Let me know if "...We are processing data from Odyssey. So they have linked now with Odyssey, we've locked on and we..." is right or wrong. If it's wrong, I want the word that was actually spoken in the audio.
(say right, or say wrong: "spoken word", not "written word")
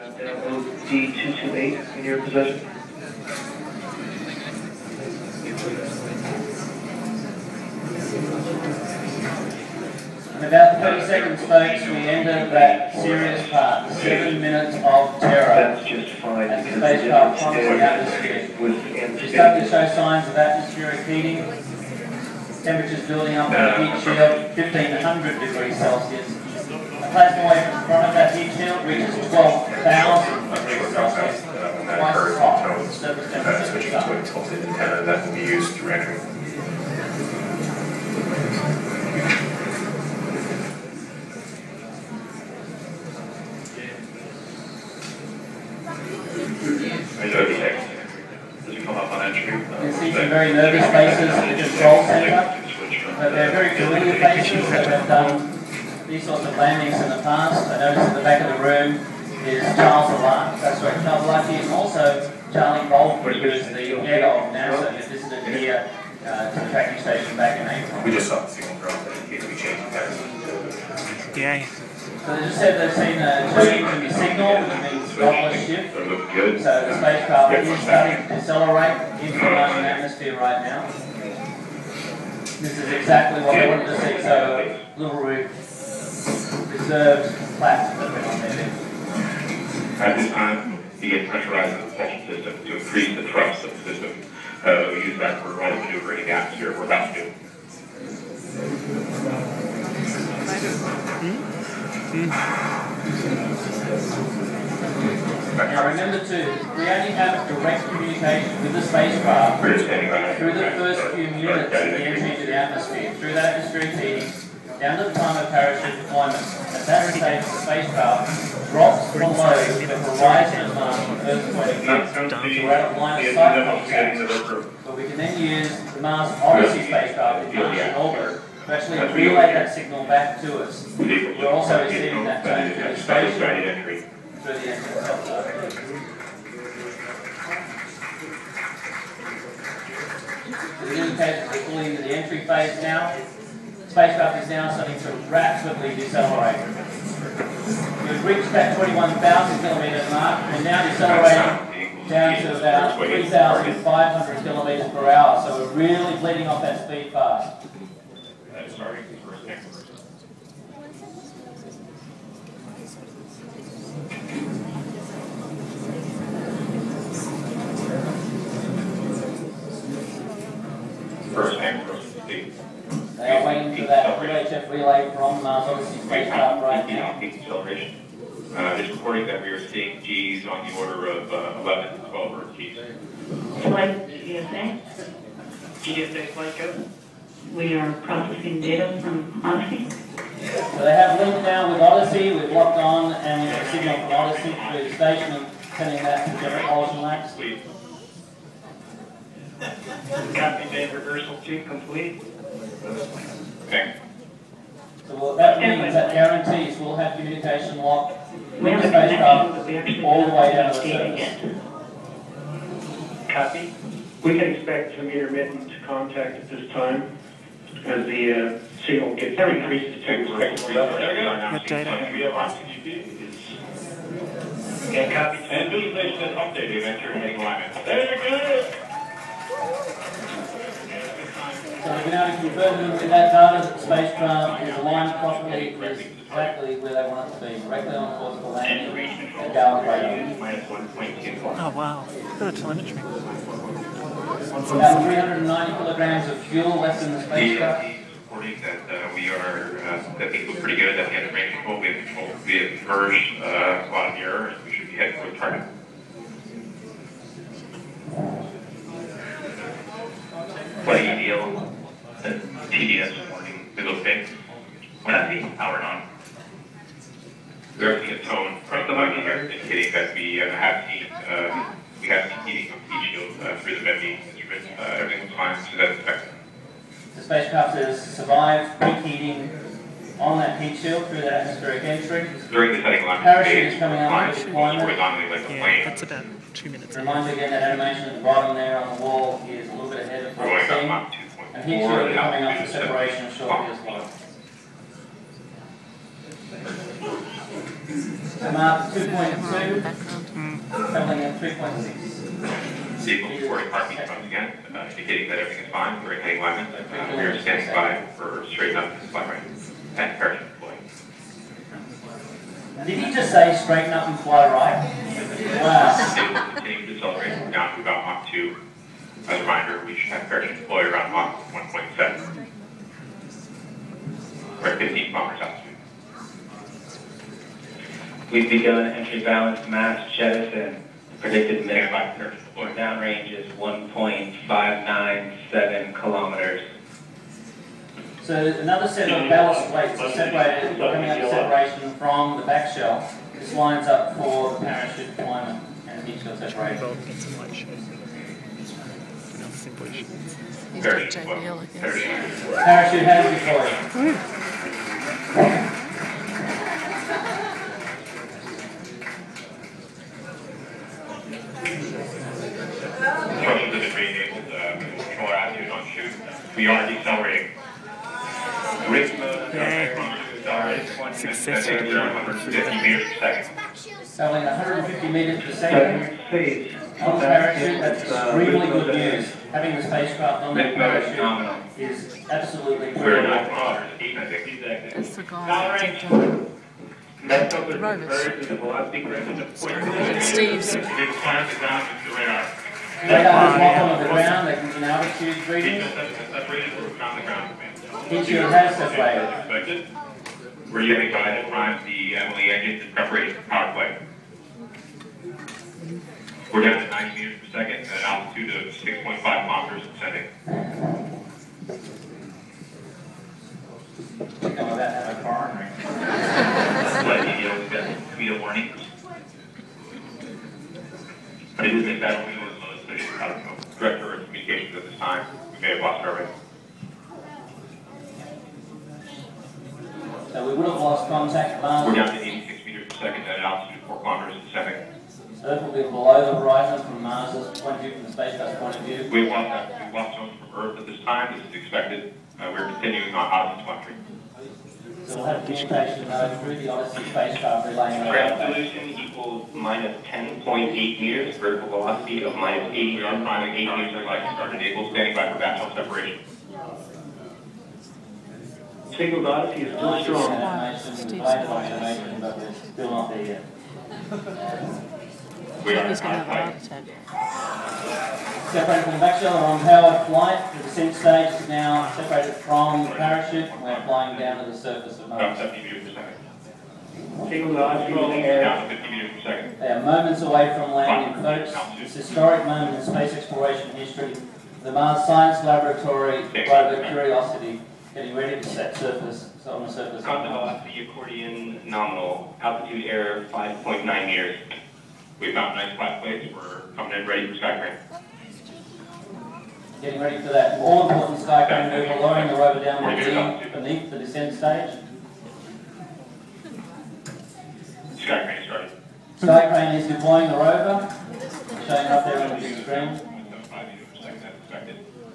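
right.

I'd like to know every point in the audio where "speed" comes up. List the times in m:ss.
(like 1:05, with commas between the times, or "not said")
2:36.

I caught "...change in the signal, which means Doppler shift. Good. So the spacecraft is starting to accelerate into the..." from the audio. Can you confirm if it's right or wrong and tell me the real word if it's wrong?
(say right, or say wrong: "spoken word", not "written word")
right.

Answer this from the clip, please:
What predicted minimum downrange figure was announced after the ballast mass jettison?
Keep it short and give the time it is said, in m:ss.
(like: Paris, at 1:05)
1.597 kilometers, at 5:33.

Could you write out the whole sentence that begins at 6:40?
We're using guided prime the MLE engines in preparation for power play.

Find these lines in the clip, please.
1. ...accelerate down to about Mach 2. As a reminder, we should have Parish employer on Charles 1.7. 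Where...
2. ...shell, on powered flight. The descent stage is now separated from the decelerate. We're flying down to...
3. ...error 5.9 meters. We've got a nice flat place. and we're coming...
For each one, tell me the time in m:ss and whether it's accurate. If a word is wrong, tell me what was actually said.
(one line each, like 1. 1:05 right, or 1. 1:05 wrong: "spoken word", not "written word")
1. 5:17 wrong: "Mach", not "Charles"
2. 7:49 wrong: "parachute", not "decelerate"
3. 8:12 right.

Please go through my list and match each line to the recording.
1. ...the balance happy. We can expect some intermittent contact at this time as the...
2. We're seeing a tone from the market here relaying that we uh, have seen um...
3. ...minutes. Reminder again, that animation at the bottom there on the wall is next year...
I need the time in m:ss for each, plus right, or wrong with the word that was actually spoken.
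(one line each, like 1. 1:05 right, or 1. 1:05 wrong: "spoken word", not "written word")
1. 3:30 wrong: "surface", not "balance"
2. 4:27 wrong: "indicating", not "relaying"
3. 4:46 right.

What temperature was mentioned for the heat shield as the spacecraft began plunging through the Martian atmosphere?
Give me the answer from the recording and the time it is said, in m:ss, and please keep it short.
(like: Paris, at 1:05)
1500 degrees Celsius, at 0:24.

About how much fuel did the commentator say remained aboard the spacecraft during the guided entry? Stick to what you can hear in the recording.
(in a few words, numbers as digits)
390 kilograms.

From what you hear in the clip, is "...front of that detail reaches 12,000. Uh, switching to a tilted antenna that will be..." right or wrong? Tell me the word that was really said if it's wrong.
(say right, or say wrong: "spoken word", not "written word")
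right.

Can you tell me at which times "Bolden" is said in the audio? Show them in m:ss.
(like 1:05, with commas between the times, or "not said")
1:02.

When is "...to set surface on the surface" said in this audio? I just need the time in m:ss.
8:08.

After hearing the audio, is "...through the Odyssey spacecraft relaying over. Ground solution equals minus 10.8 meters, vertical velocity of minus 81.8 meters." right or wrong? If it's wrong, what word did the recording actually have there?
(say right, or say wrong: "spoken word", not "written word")
right.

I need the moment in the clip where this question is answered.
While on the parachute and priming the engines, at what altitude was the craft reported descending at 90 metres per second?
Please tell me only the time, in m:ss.
6:48.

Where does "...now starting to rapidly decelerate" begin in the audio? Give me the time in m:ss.
2:24.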